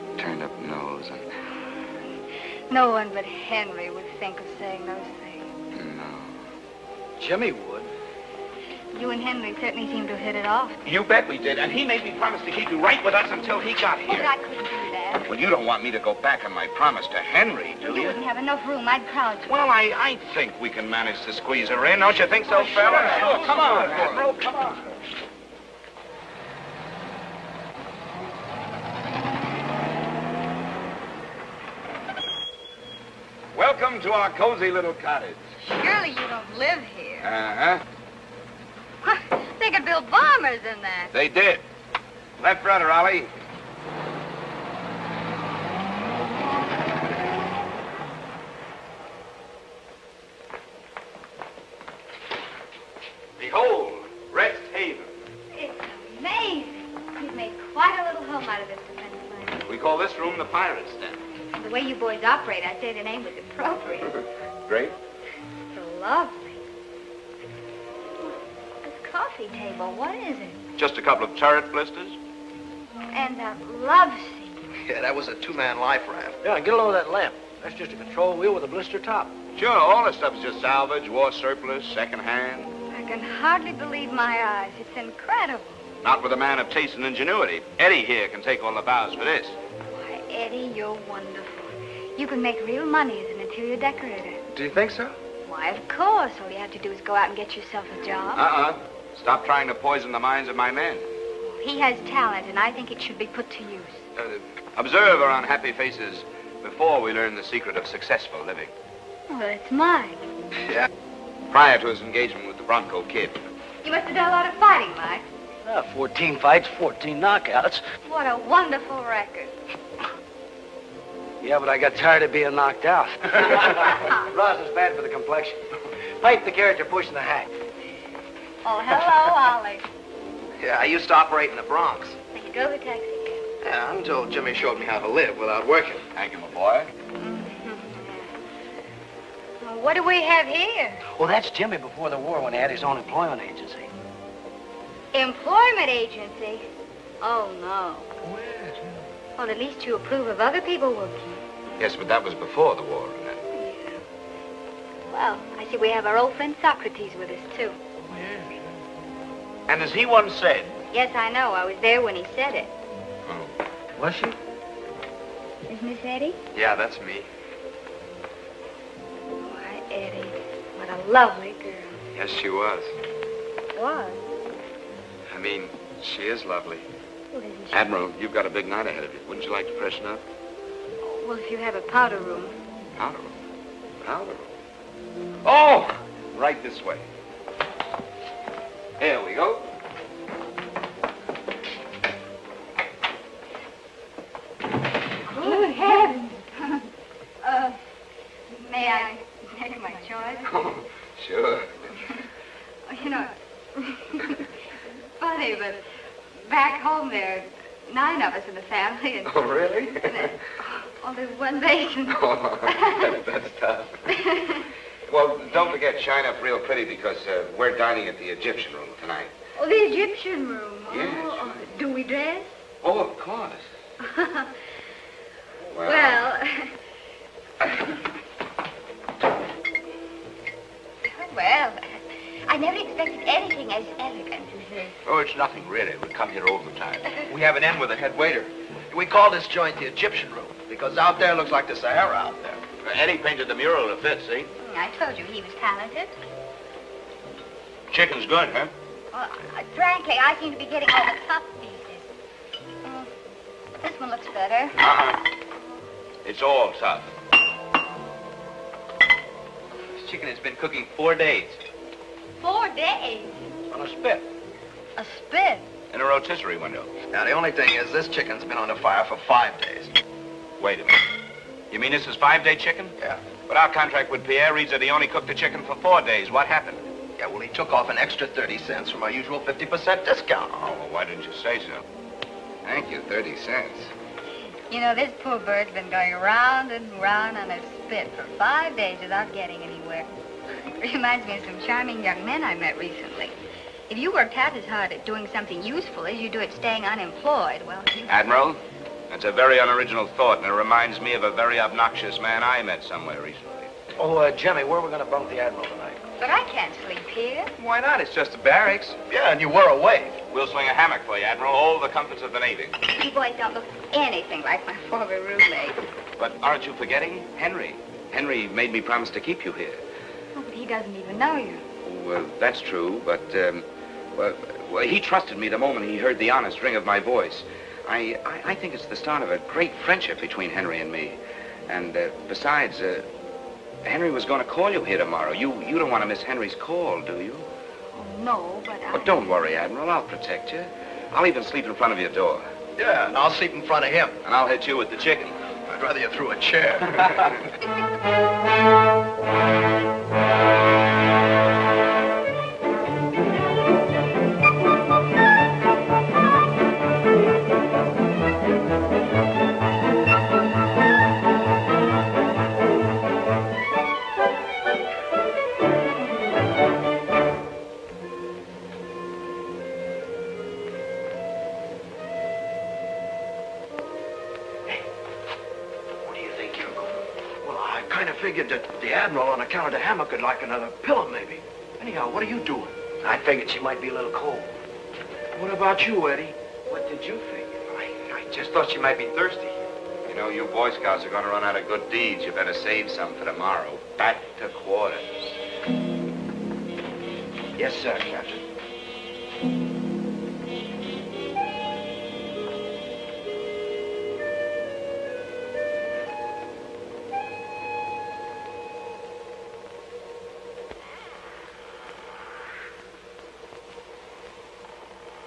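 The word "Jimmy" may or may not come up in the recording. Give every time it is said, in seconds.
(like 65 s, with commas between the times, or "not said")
7 s, 134 s, 141 s, 304 s.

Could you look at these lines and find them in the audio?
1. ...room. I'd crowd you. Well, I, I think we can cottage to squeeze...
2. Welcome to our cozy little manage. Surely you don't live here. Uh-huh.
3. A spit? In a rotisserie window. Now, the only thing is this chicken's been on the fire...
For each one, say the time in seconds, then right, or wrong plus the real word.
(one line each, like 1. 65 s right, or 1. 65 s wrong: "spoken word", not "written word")
1. 18 s wrong: "manage", not "cottage"
2. 33 s wrong: "cottage", not "manage"
3. 264 s right.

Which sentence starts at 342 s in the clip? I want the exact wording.
Yeah, and I'll sleep in front of him.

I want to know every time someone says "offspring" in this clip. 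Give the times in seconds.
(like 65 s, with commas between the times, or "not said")
not said.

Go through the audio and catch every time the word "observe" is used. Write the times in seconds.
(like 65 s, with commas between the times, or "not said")
104 s.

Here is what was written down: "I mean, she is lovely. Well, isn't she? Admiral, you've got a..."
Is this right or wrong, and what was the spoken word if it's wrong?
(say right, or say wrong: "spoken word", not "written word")
right.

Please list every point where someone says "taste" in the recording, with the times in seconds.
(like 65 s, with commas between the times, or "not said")
86 s.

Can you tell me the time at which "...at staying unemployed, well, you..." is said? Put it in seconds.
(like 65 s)
296 s.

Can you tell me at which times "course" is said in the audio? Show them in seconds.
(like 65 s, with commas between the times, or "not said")
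95 s, 223 s.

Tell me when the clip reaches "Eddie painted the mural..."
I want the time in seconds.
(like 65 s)
242 s.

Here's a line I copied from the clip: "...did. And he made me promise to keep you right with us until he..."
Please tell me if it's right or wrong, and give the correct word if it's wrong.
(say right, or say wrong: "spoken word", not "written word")
right.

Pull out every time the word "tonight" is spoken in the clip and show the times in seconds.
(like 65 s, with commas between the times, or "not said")
219 s, 305 s.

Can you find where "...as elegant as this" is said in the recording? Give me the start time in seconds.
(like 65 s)
233 s.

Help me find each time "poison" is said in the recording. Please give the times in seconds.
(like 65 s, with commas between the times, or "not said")
99 s.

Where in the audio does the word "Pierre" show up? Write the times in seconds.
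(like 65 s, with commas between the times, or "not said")
274 s.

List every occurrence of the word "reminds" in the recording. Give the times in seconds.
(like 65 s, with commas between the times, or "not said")
290 s, 300 s.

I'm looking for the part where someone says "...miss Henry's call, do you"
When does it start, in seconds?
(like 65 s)
336 s.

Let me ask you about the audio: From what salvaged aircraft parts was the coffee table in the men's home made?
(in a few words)
turret blisters.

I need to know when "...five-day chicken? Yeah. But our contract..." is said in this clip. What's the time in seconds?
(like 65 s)
272 s.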